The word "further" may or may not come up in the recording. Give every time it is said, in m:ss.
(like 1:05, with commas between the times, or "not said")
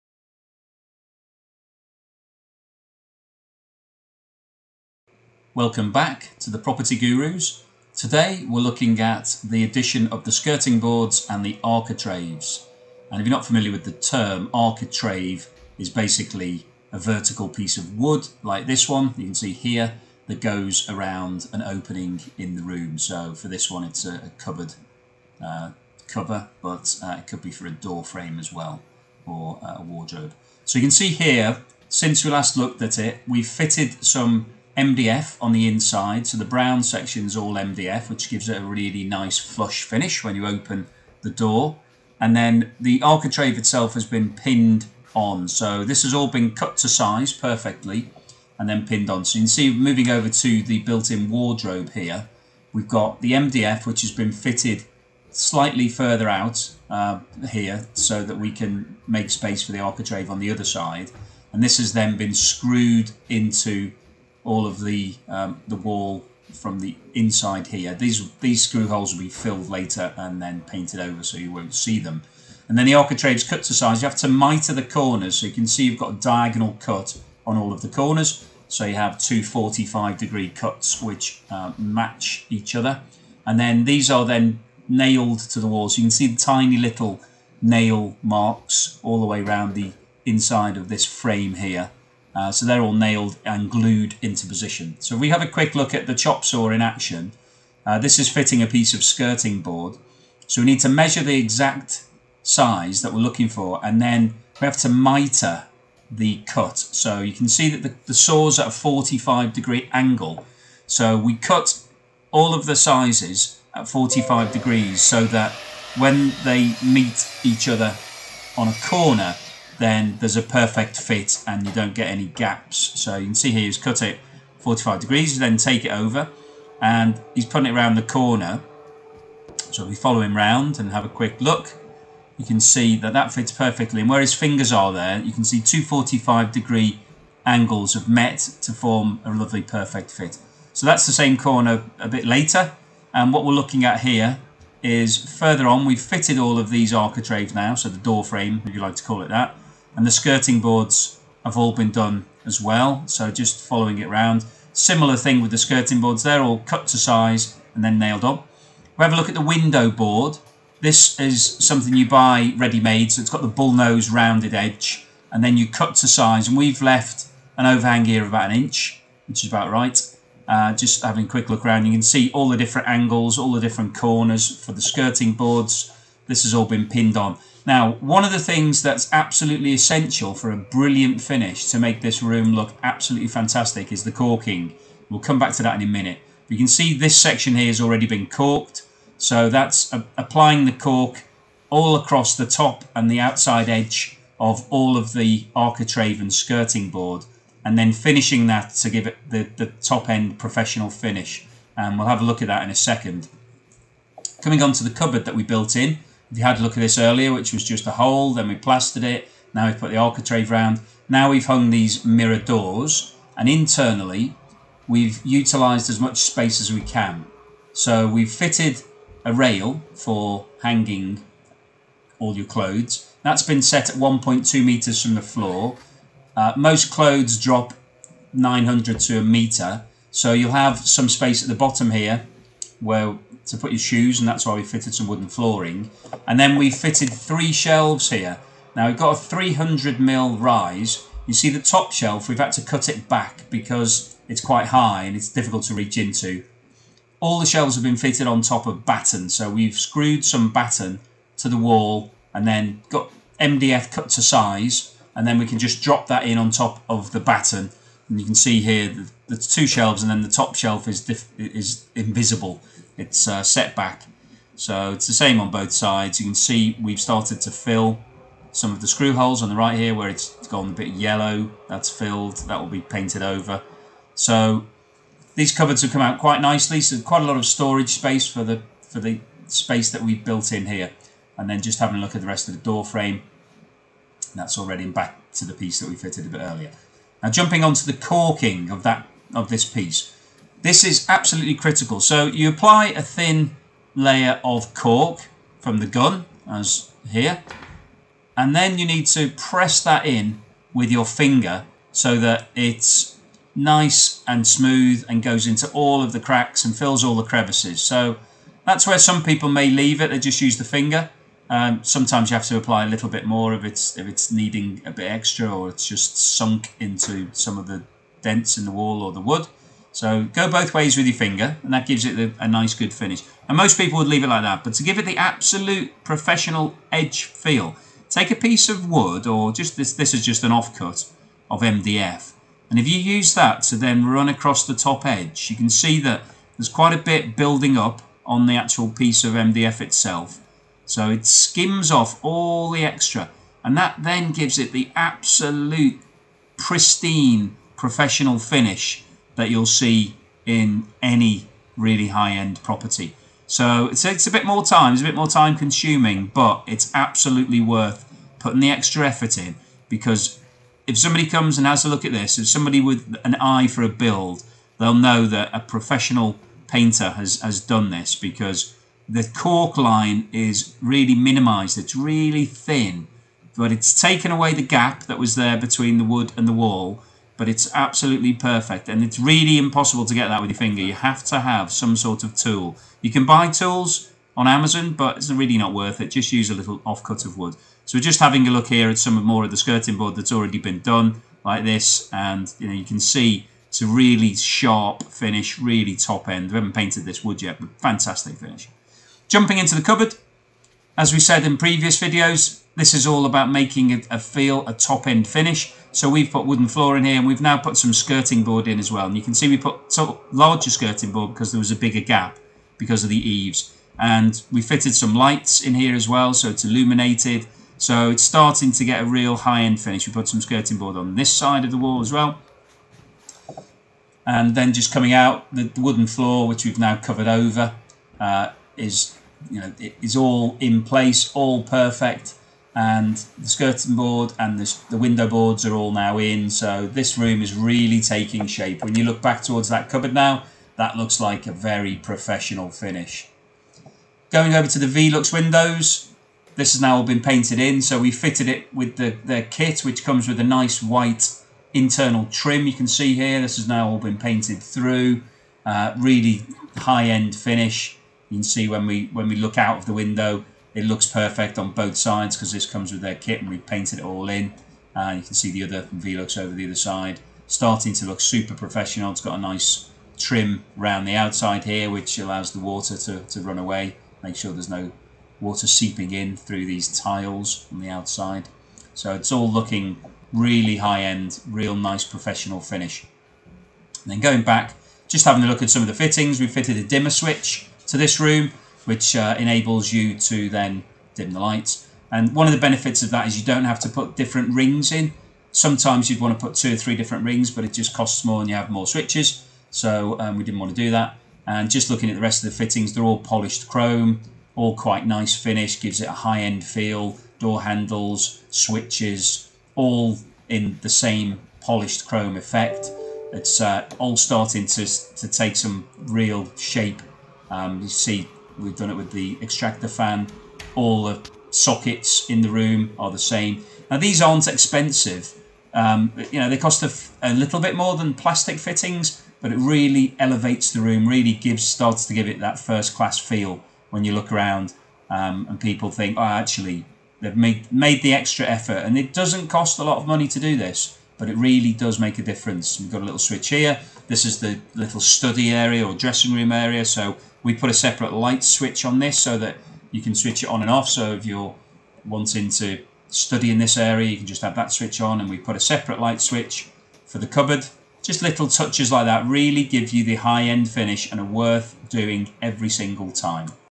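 0:55, 2:25.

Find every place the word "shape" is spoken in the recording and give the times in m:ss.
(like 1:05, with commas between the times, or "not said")
7:18, 8:36.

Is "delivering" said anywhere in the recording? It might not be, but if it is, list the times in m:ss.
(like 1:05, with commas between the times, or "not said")
not said.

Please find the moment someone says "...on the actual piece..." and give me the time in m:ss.
5:38.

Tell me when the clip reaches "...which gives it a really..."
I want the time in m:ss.
0:38.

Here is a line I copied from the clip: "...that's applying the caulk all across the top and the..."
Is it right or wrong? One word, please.
right.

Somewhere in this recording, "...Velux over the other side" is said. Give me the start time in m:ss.
7:45.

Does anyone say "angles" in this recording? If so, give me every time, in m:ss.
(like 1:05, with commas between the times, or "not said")
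1:49, 2:17, 2:52.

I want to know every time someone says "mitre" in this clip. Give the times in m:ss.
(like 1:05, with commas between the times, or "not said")
1:14, 1:44.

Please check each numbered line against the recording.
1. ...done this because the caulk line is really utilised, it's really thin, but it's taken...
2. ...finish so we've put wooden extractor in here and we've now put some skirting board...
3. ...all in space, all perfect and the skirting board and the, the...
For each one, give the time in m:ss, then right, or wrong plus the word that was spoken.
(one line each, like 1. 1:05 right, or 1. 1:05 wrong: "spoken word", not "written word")
1. 6:07 wrong: "minimized", not "utilised"
2. 6:45 wrong: "floor", not "extractor"
3. 7:10 wrong: "place", not "space".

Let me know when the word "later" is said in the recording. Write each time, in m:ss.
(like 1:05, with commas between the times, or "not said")
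1:09, 2:22.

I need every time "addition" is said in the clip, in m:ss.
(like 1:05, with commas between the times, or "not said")
0:09.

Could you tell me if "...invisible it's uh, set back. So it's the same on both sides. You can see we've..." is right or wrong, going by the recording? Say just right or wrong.
right.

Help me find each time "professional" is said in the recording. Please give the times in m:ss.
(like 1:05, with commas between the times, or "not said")
3:20, 5:26, 5:47, 6:05, 7:21, 7:48, 8:02.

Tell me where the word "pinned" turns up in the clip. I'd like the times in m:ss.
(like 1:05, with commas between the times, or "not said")
0:44, 0:48, 2:56.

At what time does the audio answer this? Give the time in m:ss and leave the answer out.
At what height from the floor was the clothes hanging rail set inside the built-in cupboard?
3:43.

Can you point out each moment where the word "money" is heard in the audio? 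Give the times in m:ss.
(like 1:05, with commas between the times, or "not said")
9:00.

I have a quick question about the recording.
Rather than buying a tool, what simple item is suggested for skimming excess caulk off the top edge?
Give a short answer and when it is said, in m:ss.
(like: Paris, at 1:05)
Offcut of MDF, at 5:30.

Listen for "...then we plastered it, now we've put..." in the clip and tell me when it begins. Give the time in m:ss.
3:28.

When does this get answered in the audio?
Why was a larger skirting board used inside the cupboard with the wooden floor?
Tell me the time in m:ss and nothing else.
6:52.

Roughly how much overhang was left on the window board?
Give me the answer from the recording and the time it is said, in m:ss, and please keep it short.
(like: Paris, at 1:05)
About an inch, at 2:48.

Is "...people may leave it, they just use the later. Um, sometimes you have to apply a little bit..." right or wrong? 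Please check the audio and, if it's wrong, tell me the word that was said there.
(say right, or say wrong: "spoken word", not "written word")
wrong: "finger", not "later".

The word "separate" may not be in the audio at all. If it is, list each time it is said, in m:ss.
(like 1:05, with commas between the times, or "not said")
9:07, 9:15.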